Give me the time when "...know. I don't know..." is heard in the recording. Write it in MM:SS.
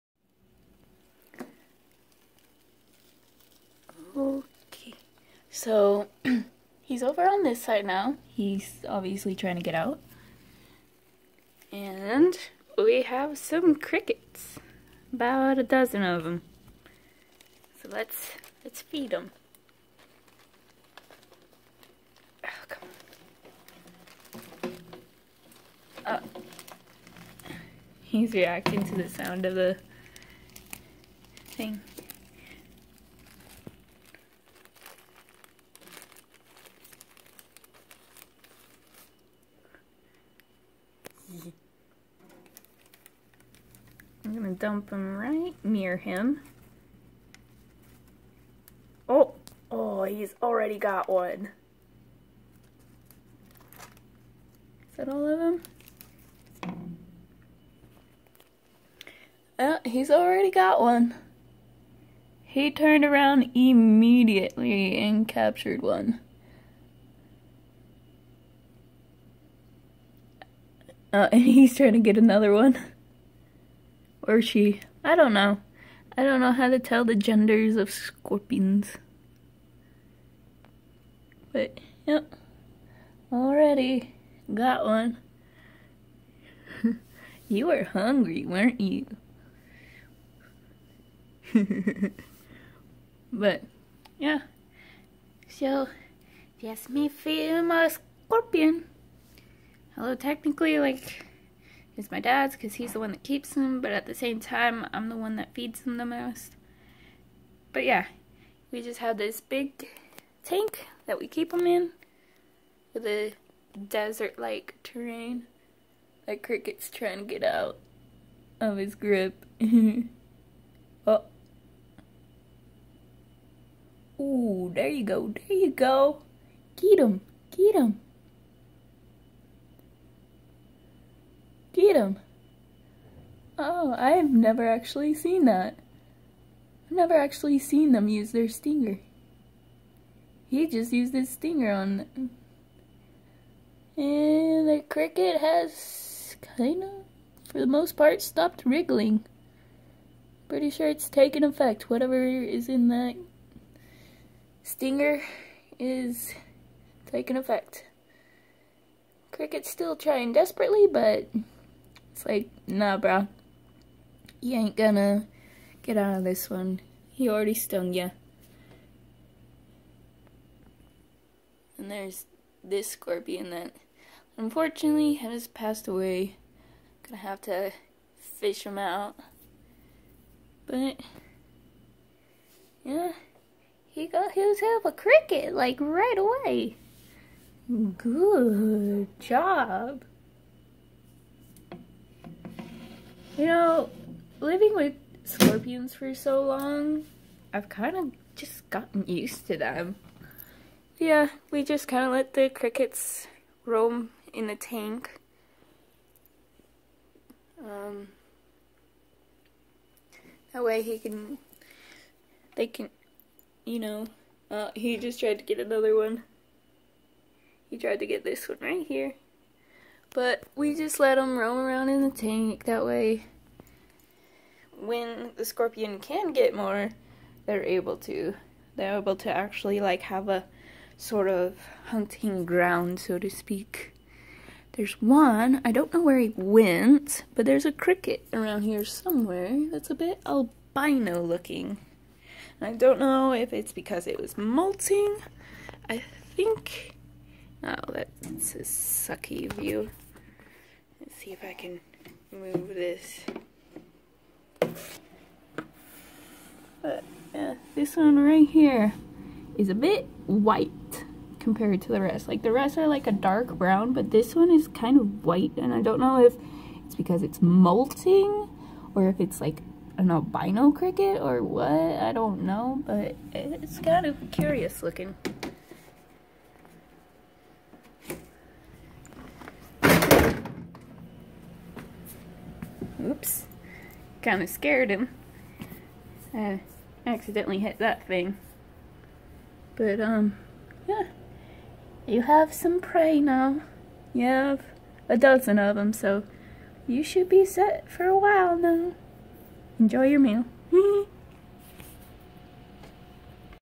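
01:15.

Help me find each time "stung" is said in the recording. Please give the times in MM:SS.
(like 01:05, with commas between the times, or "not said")
02:47.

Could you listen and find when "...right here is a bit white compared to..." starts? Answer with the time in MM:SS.
04:18.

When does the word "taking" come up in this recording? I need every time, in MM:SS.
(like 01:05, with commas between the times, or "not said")
02:37.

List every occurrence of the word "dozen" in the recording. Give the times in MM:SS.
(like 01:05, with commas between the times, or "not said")
00:15, 04:55.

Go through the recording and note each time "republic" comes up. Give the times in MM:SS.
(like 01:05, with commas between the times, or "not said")
not said.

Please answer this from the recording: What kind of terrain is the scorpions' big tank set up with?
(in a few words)
Desert-like.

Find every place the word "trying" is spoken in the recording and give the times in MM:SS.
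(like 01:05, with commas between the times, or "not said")
00:09, 01:11, 01:56, 02:39.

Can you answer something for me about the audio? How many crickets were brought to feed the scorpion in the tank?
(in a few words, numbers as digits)
12.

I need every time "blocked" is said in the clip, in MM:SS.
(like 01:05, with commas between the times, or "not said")
not said.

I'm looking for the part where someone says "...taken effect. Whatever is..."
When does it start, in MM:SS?
02:31.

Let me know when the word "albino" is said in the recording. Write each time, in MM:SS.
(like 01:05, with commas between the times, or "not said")
04:00, 04:30.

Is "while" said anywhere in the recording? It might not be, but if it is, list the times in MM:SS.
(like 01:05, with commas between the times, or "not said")
04:58.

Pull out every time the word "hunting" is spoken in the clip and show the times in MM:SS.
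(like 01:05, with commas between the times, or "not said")
03:51.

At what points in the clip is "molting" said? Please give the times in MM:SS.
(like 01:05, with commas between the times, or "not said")
04:04, 04:27.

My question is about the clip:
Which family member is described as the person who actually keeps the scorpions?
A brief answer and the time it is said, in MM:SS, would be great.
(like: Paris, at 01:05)
Dad, at 01:42.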